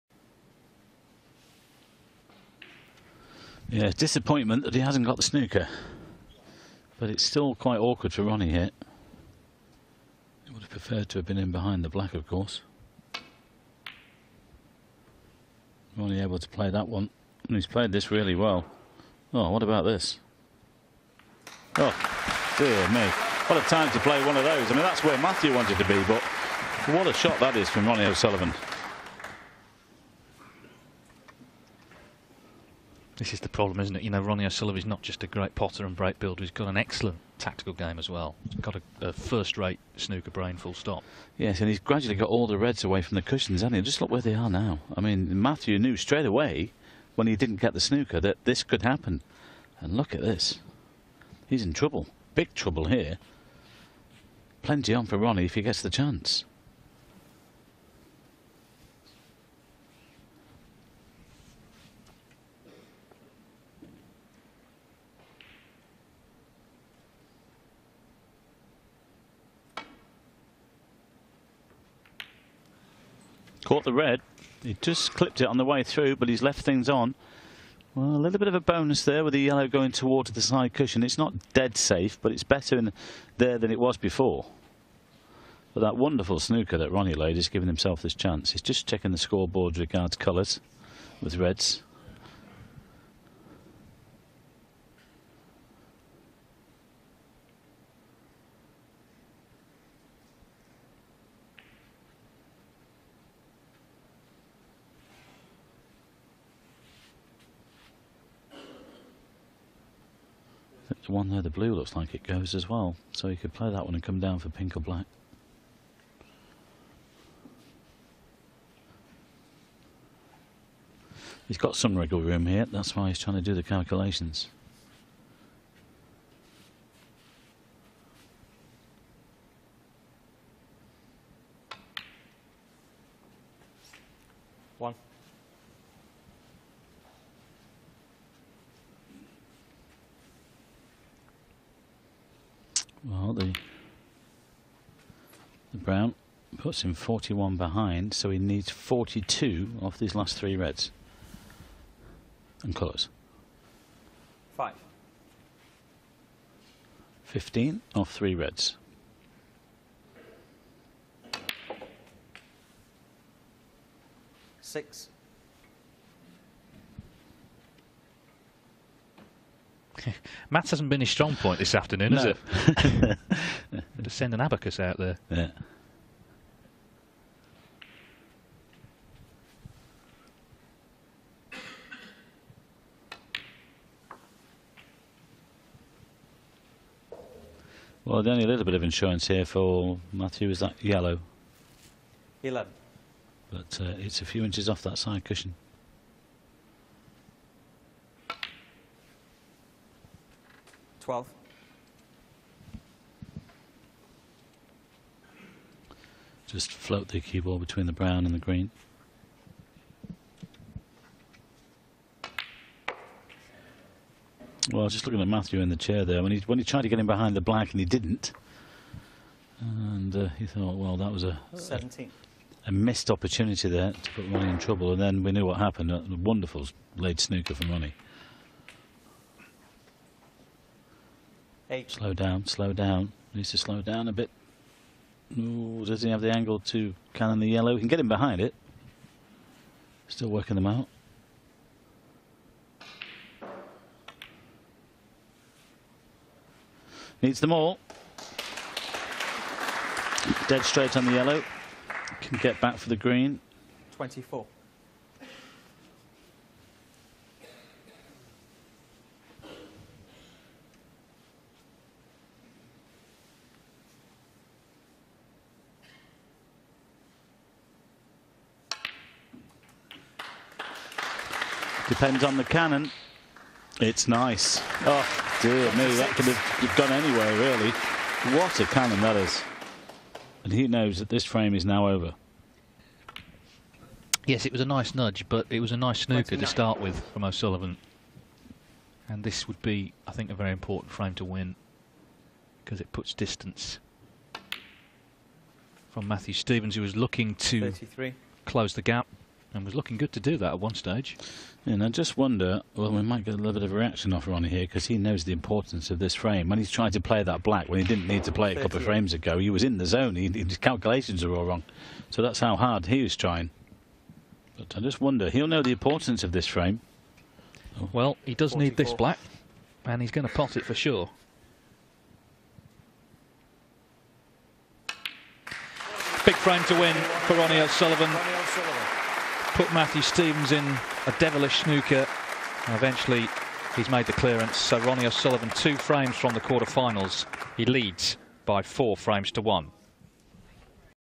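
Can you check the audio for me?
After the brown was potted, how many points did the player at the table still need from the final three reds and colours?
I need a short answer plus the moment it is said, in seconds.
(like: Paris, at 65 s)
42, at 148 s.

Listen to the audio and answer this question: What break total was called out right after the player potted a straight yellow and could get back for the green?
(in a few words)
24.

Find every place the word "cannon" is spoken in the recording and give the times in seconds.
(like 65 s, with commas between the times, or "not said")
237 s, 272 s, 278 s.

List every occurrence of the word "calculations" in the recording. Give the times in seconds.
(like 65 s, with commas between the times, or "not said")
123 s, 310 s.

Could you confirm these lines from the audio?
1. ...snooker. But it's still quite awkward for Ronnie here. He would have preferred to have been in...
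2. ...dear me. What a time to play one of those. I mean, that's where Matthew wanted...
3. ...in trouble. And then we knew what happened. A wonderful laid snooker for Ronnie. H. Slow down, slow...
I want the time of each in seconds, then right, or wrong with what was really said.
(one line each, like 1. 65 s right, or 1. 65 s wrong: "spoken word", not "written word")
1. 5 s right
2. 22 s right
3. 224 s right.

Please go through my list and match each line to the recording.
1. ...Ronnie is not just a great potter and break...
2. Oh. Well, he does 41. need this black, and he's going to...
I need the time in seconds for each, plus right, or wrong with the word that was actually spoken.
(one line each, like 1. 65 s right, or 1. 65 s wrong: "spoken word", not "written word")
1. 34 s right
2. 317 s wrong: "44", not "41".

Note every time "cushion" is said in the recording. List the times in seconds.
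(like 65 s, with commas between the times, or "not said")
43 s, 80 s, 195 s.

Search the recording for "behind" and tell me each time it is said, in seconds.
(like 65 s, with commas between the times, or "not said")
11 s, 147 s, 217 s, 238 s.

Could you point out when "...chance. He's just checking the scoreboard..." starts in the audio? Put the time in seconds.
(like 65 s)
88 s.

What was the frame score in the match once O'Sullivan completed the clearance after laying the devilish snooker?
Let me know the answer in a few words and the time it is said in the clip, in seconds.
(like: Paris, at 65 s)
4-1, at 338 s.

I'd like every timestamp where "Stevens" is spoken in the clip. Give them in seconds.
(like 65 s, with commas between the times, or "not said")
296 s, 330 s.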